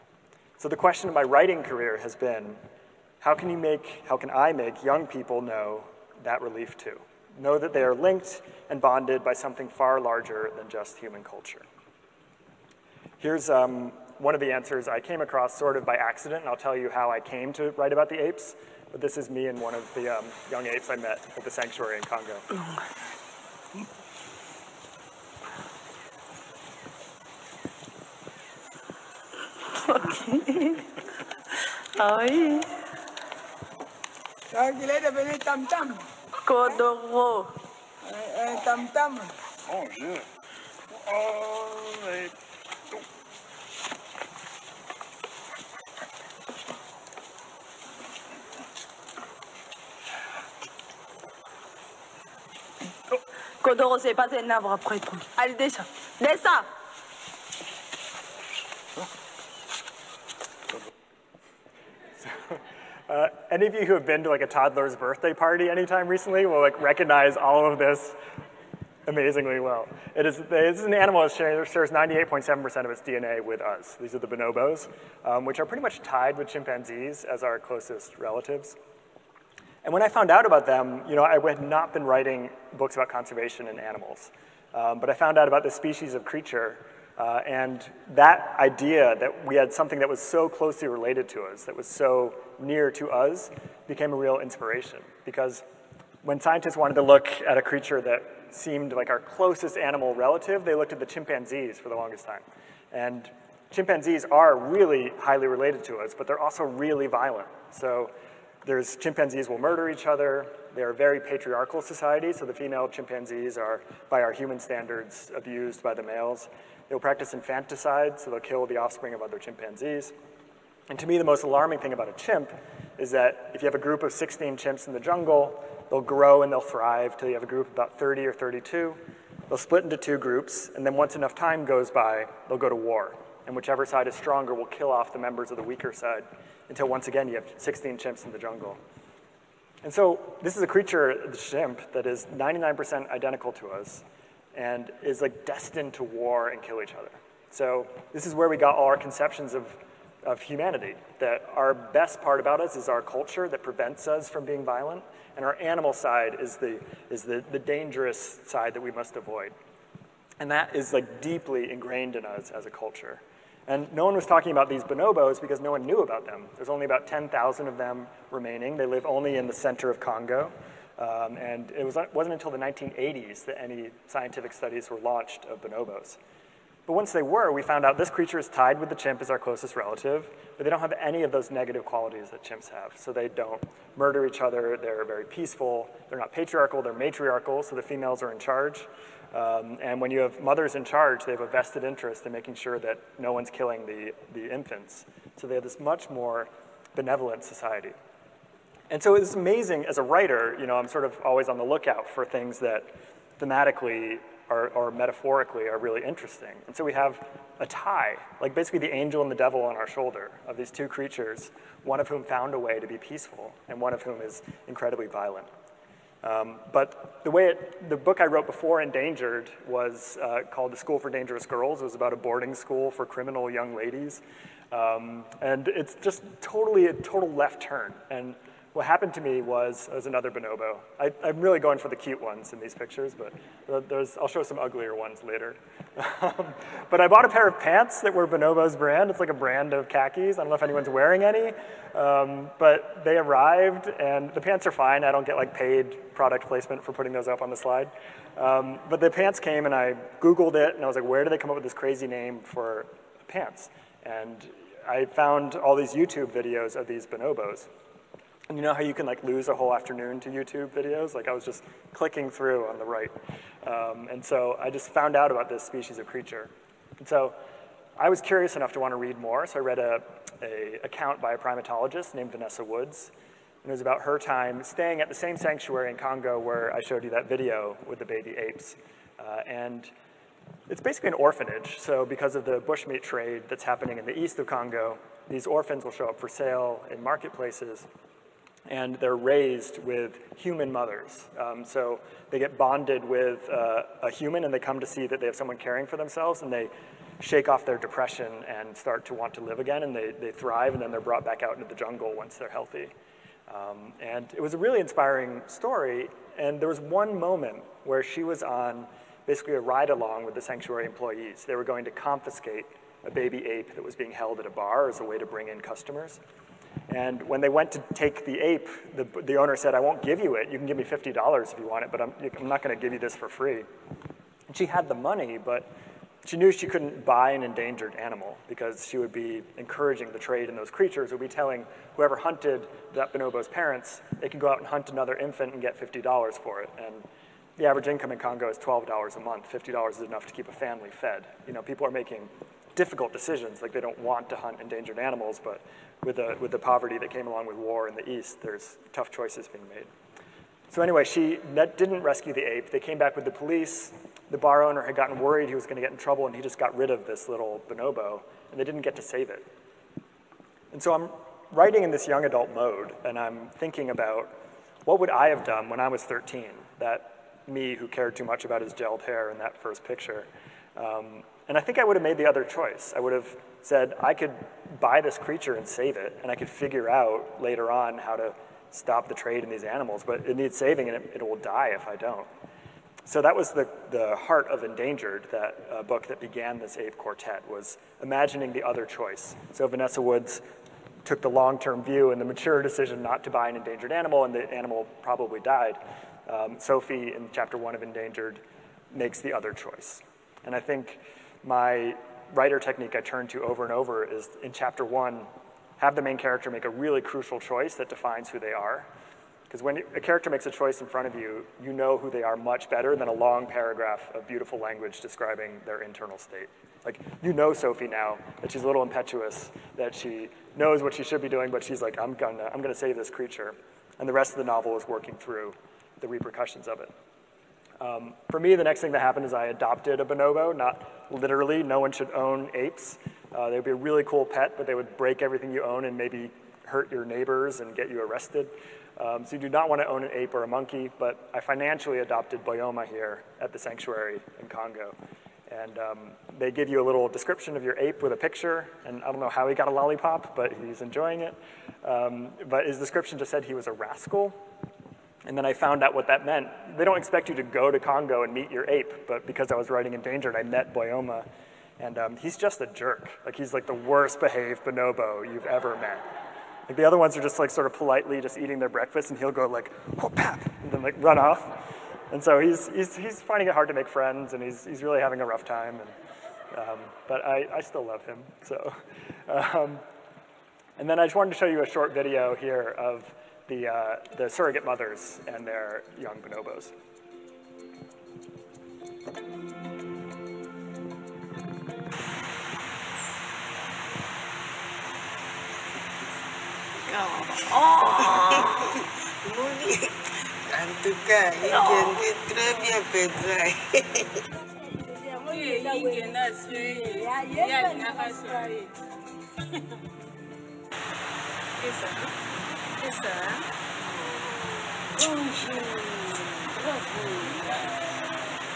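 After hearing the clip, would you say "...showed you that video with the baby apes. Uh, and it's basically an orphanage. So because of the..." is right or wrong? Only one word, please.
right.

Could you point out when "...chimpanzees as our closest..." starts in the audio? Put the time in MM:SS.
01:16.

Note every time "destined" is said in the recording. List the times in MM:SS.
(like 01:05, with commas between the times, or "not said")
02:25.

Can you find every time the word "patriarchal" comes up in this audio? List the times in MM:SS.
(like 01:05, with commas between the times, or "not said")
01:51, 03:06.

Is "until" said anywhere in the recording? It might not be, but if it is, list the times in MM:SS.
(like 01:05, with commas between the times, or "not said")
02:16, 02:52.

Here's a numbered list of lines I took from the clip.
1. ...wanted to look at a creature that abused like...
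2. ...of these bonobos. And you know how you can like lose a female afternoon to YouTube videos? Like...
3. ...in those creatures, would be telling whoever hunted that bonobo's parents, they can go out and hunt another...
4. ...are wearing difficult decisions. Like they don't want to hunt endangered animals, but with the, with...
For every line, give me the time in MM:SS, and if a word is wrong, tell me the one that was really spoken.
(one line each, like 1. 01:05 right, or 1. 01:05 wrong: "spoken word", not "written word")
1. 01:36 wrong: "seemed", not "abused"
2. 04:16 wrong: "whole", not "female"
3. 05:30 right
4. 05:41 wrong: "making", not "wearing".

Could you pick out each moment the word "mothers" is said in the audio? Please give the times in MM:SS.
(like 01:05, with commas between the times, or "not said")
03:10, 04:50, 08:04.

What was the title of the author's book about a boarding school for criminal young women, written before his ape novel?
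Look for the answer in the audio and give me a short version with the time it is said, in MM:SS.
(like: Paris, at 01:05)
The School for Dangerous Girls, at 03:40.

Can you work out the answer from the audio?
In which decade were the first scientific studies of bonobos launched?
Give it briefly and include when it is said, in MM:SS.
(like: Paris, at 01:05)
1980s, at 02:52.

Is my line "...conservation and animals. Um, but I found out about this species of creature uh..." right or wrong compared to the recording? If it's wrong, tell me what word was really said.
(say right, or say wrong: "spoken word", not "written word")
right.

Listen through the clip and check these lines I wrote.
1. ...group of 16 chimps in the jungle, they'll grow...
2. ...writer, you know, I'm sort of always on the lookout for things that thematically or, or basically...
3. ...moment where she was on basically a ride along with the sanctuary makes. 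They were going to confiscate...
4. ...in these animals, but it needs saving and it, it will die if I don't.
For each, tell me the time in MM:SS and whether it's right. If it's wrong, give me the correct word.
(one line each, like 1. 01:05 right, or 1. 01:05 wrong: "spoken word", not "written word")
1. 02:03 right
2. 03:20 wrong: "metaphorically", not "basically"
3. 05:07 wrong: "employees", not "makes"
4. 06:19 right.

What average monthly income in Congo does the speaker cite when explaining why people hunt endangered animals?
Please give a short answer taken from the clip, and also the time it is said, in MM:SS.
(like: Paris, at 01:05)
$12, at 05:38.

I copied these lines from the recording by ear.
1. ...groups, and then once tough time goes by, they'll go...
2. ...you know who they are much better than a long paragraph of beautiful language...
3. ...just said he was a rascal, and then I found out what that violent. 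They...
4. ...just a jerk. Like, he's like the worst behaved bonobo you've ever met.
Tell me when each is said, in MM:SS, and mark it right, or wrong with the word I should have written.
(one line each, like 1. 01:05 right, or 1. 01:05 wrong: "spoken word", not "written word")
1. 02:10 wrong: "enough", not "tough"
2. 06:51 right
3. 07:33 wrong: "meant", not "violent"
4. 07:42 right.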